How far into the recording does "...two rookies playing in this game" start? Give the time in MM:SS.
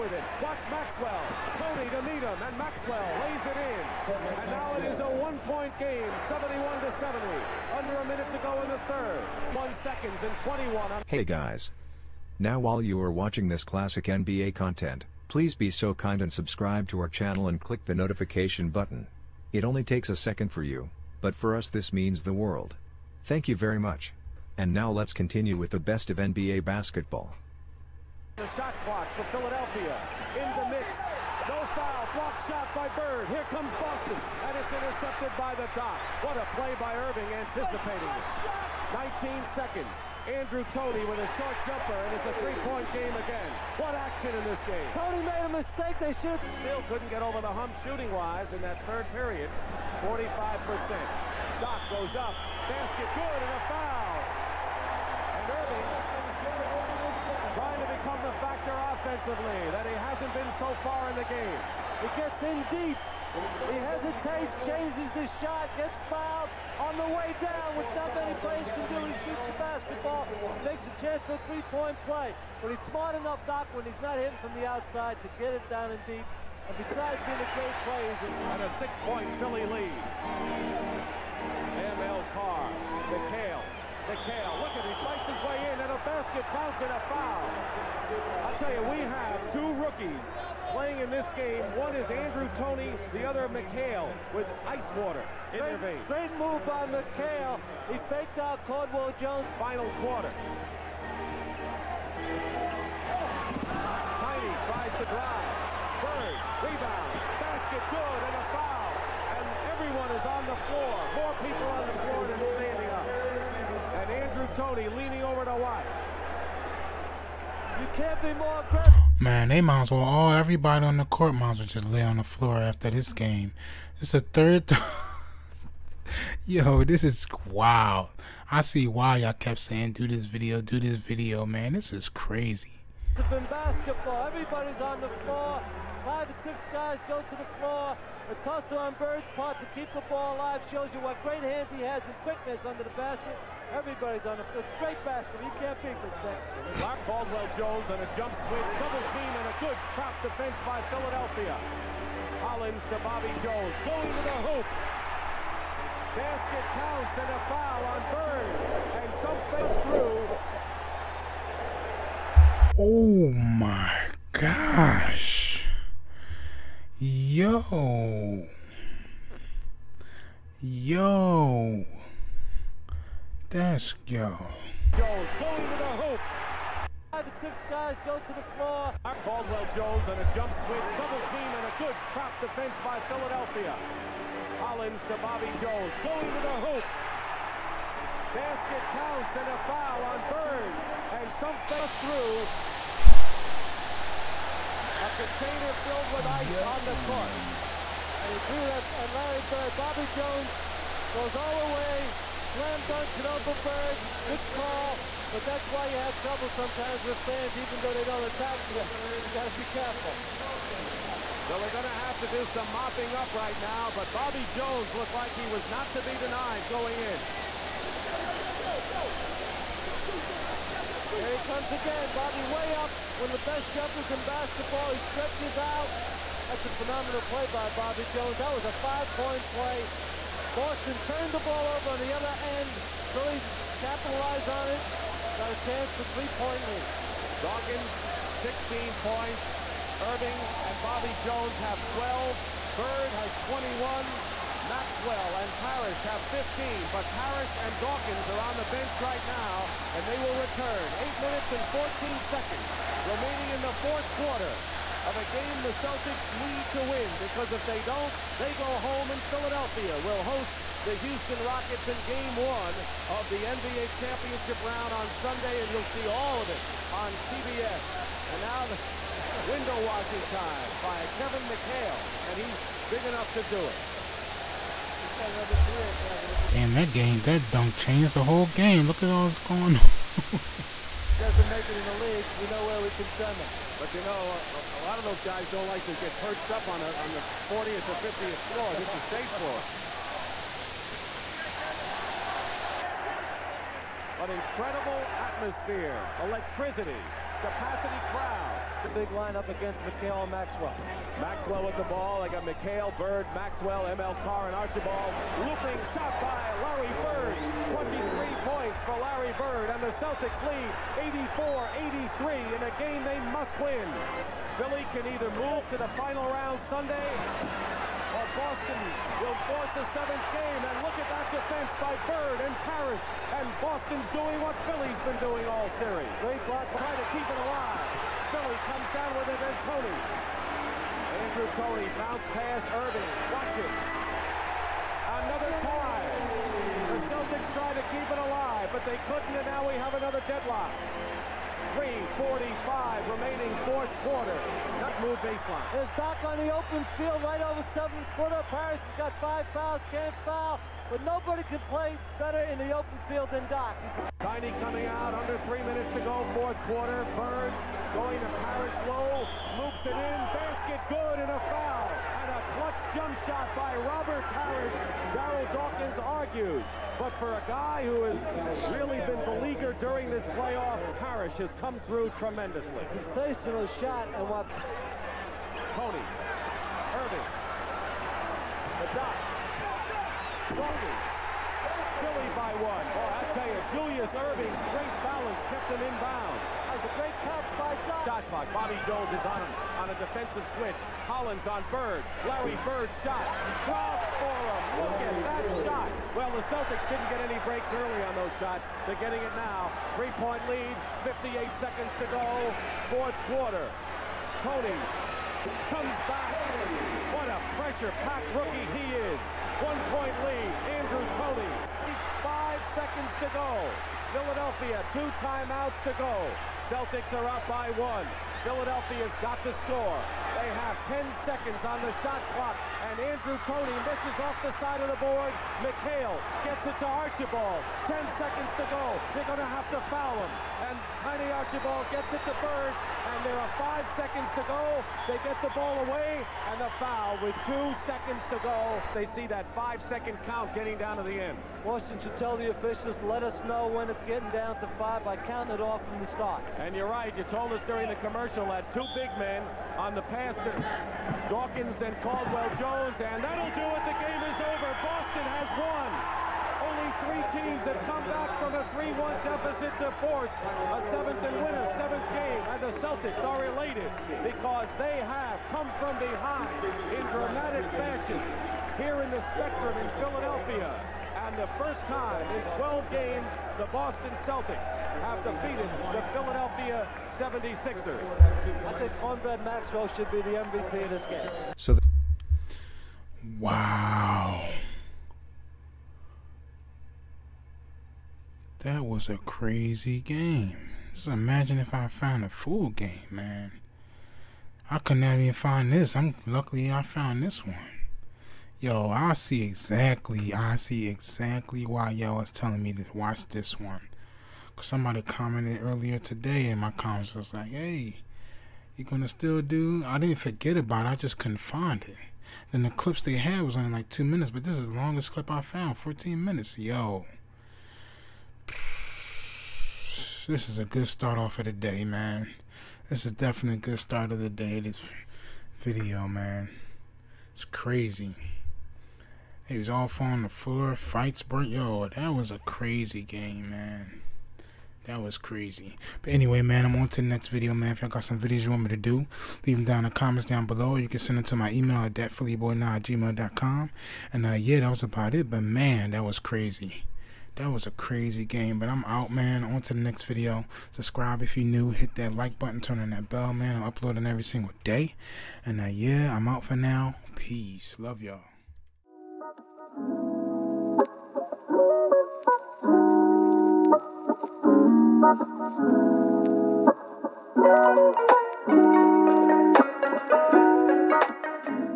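01:29.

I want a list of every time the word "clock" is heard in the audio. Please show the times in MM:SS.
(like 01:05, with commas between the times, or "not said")
00:28, 06:28, 07:02.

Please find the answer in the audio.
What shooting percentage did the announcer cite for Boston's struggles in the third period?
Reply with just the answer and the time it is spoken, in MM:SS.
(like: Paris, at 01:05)
45%, at 00:50.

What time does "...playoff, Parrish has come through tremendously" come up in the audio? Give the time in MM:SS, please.
06:10.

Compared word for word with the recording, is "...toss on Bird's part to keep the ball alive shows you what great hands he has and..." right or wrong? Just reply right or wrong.
right.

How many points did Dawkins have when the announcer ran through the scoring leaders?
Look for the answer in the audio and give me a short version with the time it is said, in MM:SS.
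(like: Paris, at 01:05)
16, at 03:58.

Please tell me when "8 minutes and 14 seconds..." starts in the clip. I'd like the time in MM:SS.
04:10.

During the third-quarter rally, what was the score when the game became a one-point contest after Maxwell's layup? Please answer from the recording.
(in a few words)
71 to 70.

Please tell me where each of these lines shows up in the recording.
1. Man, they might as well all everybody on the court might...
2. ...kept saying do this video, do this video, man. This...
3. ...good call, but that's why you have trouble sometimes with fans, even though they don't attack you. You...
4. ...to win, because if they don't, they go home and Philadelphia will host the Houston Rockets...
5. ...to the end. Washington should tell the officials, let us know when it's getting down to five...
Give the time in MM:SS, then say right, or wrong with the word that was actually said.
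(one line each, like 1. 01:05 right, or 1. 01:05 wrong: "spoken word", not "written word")
1. 01:59 right
2. 02:09 right
3. 03:24 right
4. 04:16 right
5. 07:20 right.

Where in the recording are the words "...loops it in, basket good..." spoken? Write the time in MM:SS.
05:59.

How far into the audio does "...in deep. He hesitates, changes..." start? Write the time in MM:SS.
01:02.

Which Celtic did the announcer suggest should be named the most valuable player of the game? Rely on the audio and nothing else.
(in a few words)
Cornbread Maxwell.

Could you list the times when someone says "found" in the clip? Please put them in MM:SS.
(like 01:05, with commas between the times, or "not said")
08:11, 08:16, 08:35.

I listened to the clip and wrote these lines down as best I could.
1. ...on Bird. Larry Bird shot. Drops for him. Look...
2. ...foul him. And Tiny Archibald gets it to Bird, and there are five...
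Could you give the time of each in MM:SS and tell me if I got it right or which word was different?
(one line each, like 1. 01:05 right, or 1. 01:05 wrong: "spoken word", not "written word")
1. 06:31 right
2. 07:09 right.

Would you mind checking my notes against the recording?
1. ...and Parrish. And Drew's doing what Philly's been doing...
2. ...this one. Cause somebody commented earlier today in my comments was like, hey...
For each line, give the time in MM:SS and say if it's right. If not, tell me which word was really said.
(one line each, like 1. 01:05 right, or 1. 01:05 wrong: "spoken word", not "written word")
1. 05:22 wrong: "Boston", not "Drew"
2. 08:23 right.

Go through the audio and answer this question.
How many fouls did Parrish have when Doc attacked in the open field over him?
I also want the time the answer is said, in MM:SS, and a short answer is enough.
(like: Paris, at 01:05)
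5, at 05:49.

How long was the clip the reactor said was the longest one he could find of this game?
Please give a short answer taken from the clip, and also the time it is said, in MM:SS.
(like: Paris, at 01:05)
14 minutes, at 08:35.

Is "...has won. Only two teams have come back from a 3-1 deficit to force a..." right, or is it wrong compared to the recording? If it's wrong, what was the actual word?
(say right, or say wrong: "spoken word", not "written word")
wrong: "three", not "two".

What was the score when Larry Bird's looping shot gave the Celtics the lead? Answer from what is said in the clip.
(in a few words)
84-83.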